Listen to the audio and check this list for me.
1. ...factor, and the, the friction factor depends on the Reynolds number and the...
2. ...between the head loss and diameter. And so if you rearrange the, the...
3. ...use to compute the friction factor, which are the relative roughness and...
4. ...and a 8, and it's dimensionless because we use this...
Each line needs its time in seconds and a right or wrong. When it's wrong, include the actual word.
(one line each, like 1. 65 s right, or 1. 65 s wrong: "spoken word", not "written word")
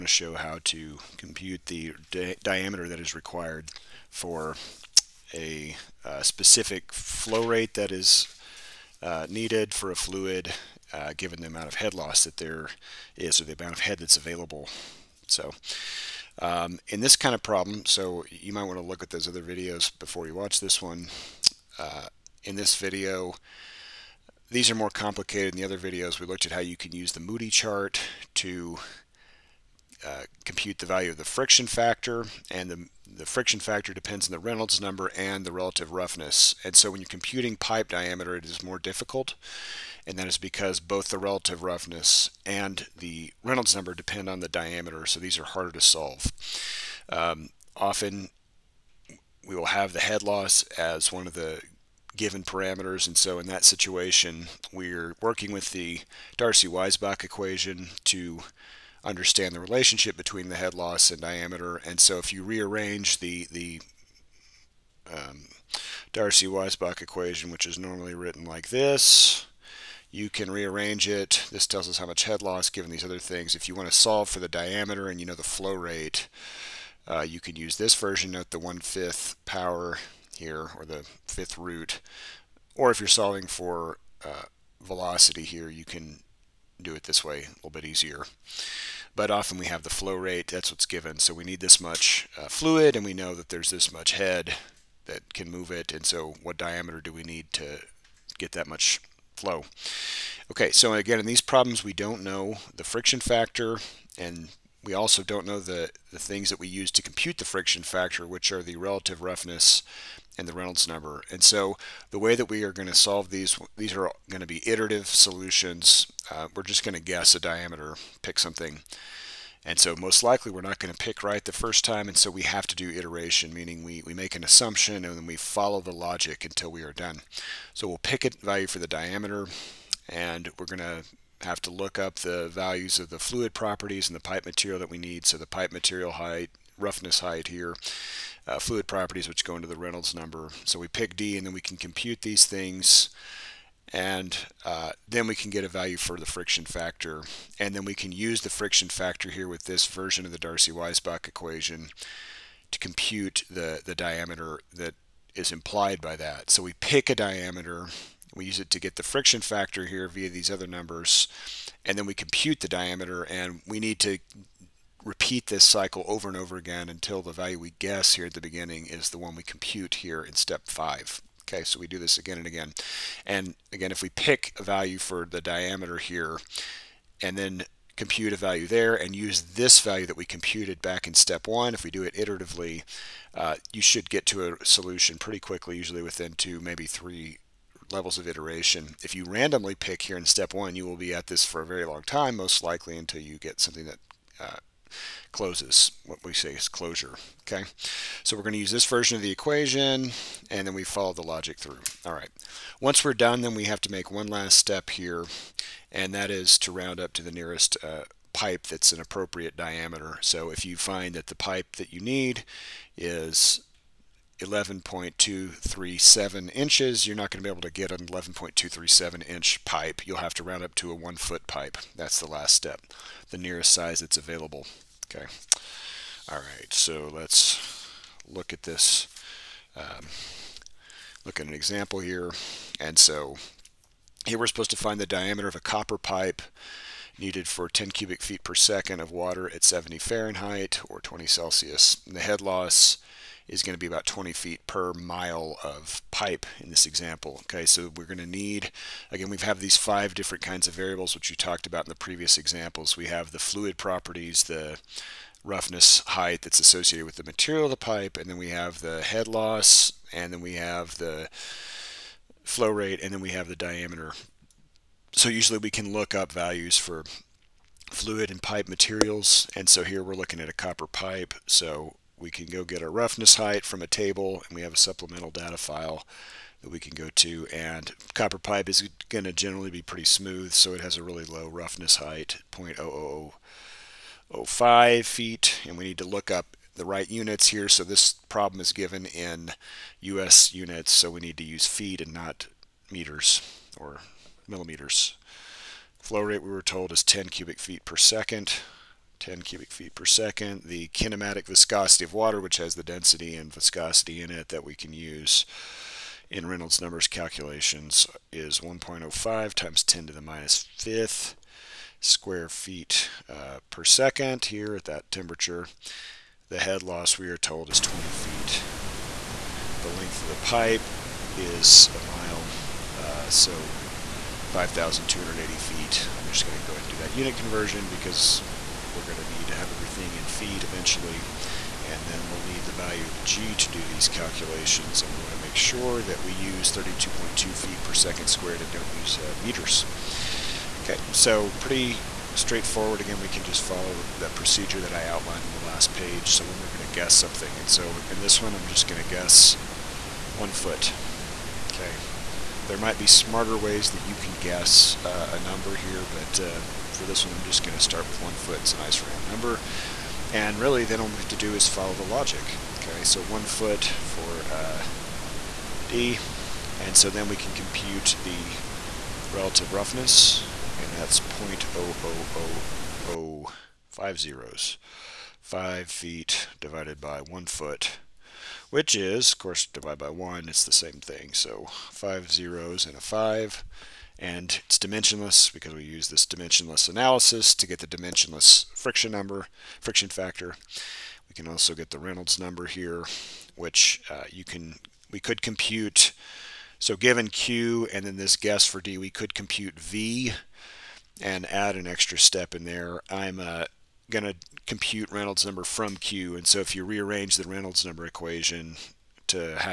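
1. 31 s right
2. 60 s right
3. 106 s right
4. 382 s wrong: "5", not "8".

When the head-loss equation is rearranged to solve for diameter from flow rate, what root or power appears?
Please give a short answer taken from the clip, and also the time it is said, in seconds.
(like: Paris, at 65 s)
one-fifth power, at 78 s.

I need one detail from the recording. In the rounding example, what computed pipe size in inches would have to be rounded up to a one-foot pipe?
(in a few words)
11.237 inches.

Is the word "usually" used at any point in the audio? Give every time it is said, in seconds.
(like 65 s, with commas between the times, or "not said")
185 s, 265 s.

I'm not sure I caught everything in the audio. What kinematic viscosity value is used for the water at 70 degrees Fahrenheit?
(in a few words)
1.05 x 10^-5 ft²/s.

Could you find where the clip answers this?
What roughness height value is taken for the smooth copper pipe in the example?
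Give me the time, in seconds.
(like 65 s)
282 s.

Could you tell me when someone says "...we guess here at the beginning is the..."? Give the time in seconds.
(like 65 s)
167 s.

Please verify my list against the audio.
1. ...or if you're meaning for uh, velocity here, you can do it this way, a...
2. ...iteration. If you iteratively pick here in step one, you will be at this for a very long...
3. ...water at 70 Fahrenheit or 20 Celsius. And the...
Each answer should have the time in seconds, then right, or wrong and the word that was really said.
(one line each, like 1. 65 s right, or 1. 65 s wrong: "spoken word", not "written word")
1. 82 s wrong: "solving", not "meaning"
2. 188 s wrong: "randomly", not "iteratively"
3. 239 s right.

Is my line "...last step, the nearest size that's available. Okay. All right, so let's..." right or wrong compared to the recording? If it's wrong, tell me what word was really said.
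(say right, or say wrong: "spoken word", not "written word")
right.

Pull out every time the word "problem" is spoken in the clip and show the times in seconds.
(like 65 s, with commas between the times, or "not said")
17 s, 101 s, 288 s.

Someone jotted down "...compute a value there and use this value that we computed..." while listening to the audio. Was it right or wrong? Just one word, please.
right.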